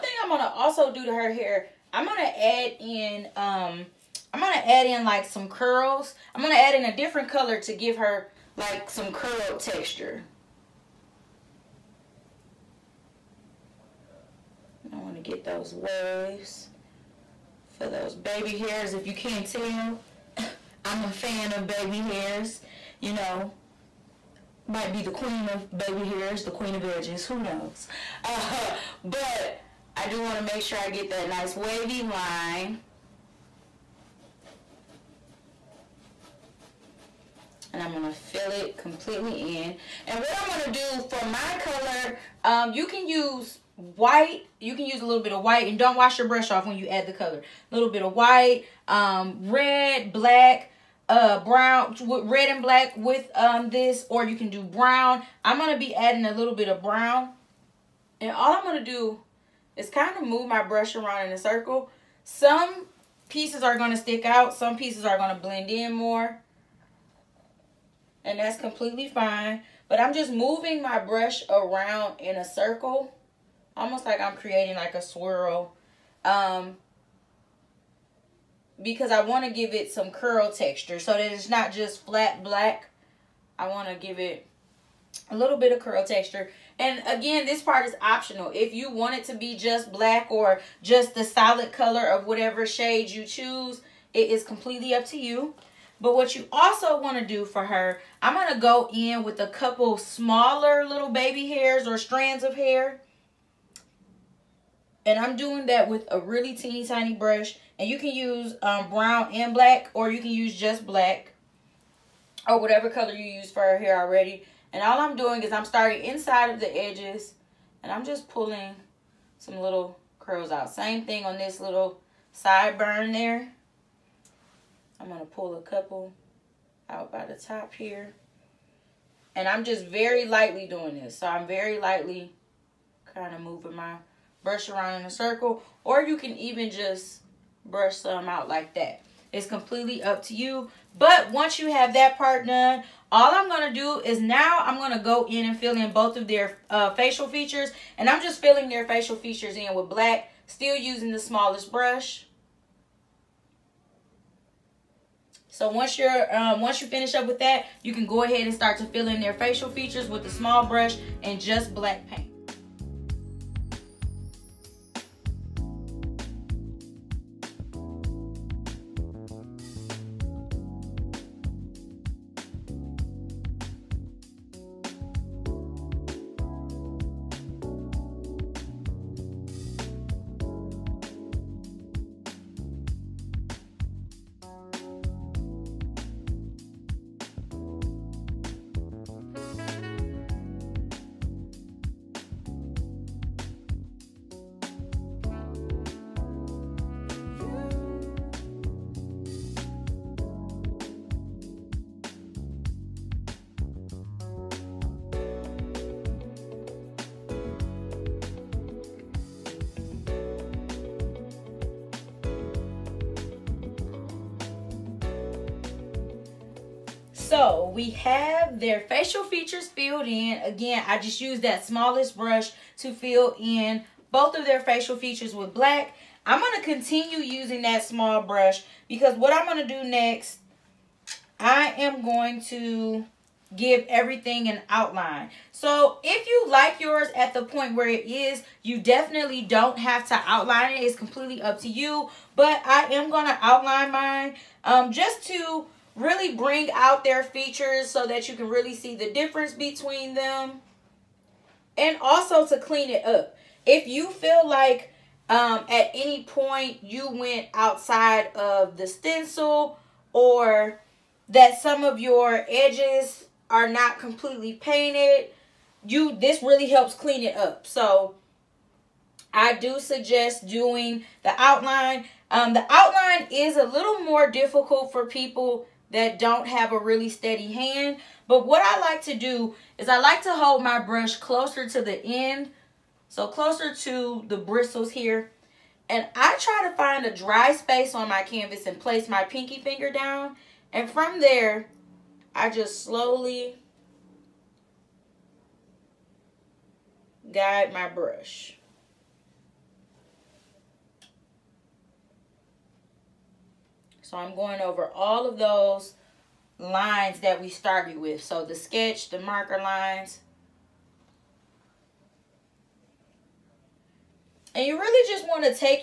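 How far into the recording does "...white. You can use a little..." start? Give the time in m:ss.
0:43.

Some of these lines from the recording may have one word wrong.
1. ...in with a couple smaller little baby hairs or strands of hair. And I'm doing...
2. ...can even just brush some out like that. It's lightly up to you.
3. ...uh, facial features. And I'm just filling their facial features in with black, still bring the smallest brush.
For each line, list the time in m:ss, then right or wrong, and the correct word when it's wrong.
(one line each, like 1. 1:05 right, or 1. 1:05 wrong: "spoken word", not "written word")
1. 1:38 right
2. 2:16 wrong: "completely", not "lightly"
3. 2:26 wrong: "using", not "bring".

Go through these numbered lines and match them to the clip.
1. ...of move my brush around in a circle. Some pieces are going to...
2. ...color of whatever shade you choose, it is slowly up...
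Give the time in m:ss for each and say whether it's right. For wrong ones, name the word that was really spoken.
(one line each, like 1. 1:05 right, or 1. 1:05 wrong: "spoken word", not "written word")
1. 1:00 right
2. 1:31 wrong: "completely", not "slowly".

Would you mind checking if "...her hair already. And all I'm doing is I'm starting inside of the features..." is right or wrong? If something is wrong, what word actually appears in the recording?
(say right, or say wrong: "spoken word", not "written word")
wrong: "edges", not "features".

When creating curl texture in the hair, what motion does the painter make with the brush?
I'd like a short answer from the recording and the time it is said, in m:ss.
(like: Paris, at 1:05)
A swirl, at 1:14.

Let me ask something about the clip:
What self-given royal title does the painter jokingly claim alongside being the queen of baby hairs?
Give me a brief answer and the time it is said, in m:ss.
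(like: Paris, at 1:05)
Queen of edges, at 0:26.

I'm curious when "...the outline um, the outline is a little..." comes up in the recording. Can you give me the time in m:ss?
4:31.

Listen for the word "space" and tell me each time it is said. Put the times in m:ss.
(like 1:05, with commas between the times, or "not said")
4:47.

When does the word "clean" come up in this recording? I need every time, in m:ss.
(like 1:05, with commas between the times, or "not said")
4:12, 4:26.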